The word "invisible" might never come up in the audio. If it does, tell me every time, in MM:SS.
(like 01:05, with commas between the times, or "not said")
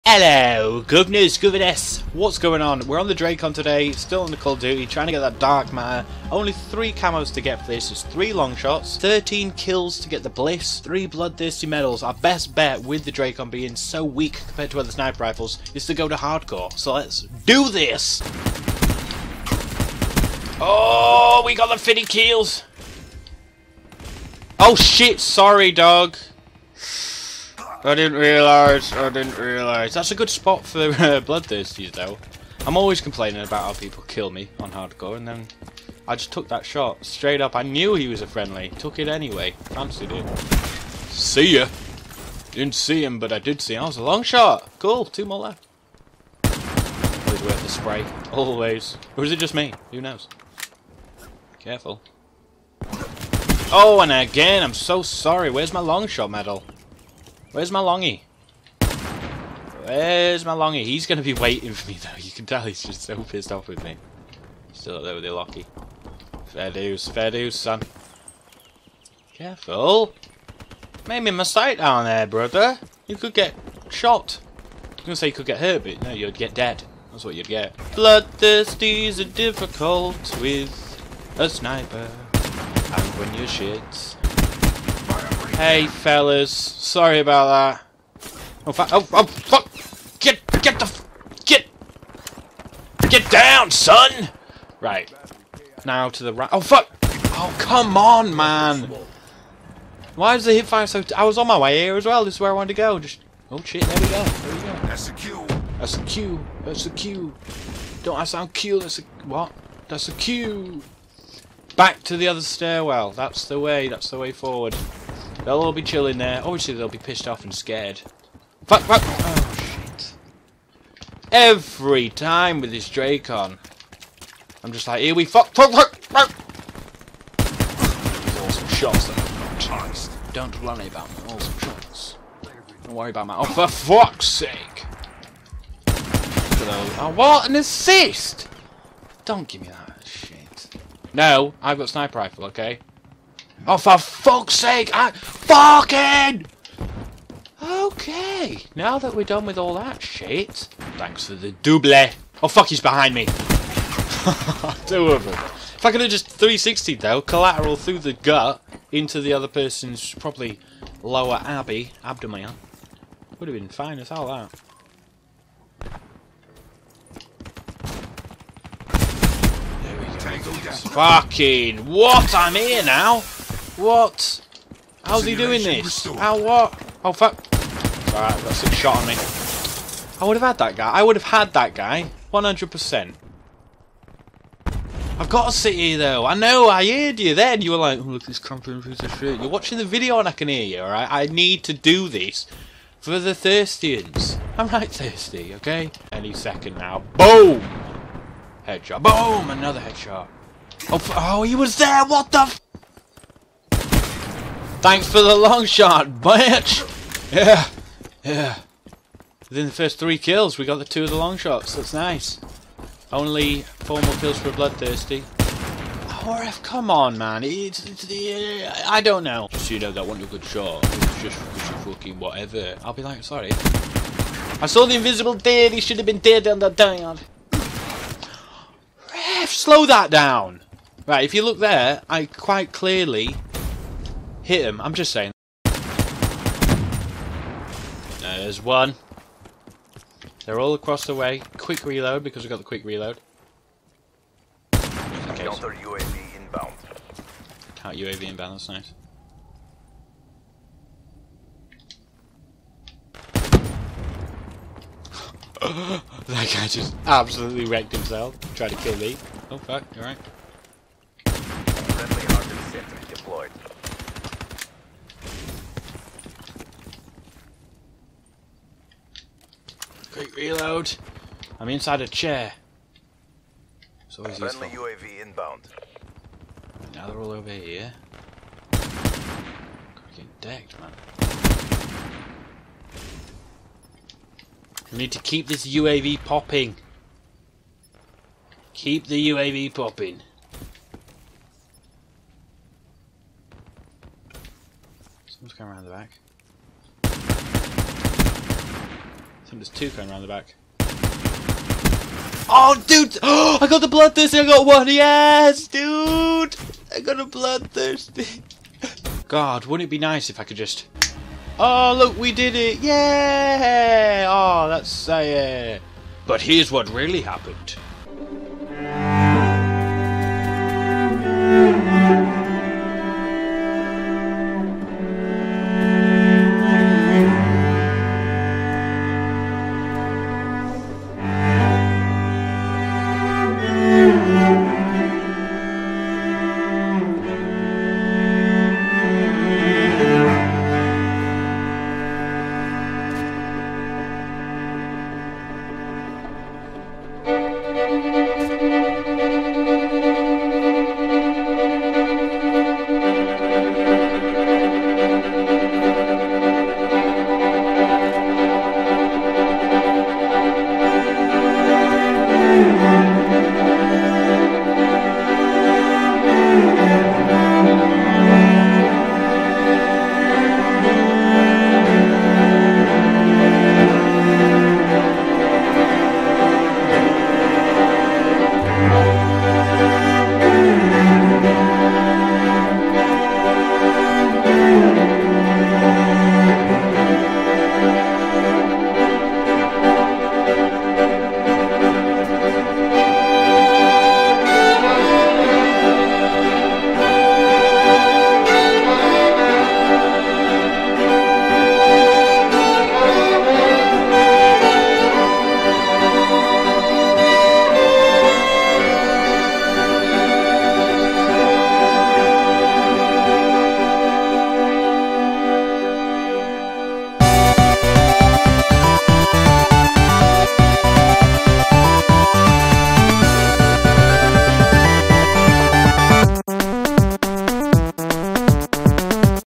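03:44.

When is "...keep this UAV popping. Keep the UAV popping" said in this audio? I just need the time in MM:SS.
04:45.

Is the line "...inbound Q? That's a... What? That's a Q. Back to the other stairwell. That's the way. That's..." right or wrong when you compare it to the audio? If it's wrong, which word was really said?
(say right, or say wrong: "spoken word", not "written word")
wrong: "sound", not "inbound".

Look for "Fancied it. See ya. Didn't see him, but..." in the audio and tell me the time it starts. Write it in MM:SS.
00:39.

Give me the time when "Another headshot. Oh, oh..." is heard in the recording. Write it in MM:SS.
03:19.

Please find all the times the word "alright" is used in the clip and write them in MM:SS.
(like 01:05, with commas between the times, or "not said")
02:58, 03:10, 04:19.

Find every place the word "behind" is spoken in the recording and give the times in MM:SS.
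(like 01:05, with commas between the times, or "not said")
02:32.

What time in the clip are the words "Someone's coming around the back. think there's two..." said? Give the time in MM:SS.
04:55.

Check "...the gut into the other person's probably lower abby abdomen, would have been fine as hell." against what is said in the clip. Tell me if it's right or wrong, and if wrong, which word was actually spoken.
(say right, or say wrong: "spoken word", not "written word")
right.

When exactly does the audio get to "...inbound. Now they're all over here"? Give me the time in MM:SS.
04:35.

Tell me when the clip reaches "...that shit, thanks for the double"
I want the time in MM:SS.
02:29.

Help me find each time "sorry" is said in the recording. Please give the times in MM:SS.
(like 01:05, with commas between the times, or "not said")
00:25, 00:55, 01:26, 03:43.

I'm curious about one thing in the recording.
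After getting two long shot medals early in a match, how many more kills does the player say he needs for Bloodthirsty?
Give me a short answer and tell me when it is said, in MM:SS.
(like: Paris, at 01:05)
4, at 03:33.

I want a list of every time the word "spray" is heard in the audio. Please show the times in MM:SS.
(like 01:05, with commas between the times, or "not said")
00:47.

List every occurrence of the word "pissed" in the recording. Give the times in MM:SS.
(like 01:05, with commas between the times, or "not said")
01:03, 01:56.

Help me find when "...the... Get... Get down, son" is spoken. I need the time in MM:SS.
01:30.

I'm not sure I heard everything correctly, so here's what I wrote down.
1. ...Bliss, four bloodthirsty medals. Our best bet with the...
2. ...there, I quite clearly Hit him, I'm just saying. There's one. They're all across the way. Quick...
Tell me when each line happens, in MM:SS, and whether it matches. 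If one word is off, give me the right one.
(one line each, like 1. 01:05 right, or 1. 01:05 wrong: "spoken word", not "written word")
1. 00:10 wrong: "three", not "four"
2. 03:51 right.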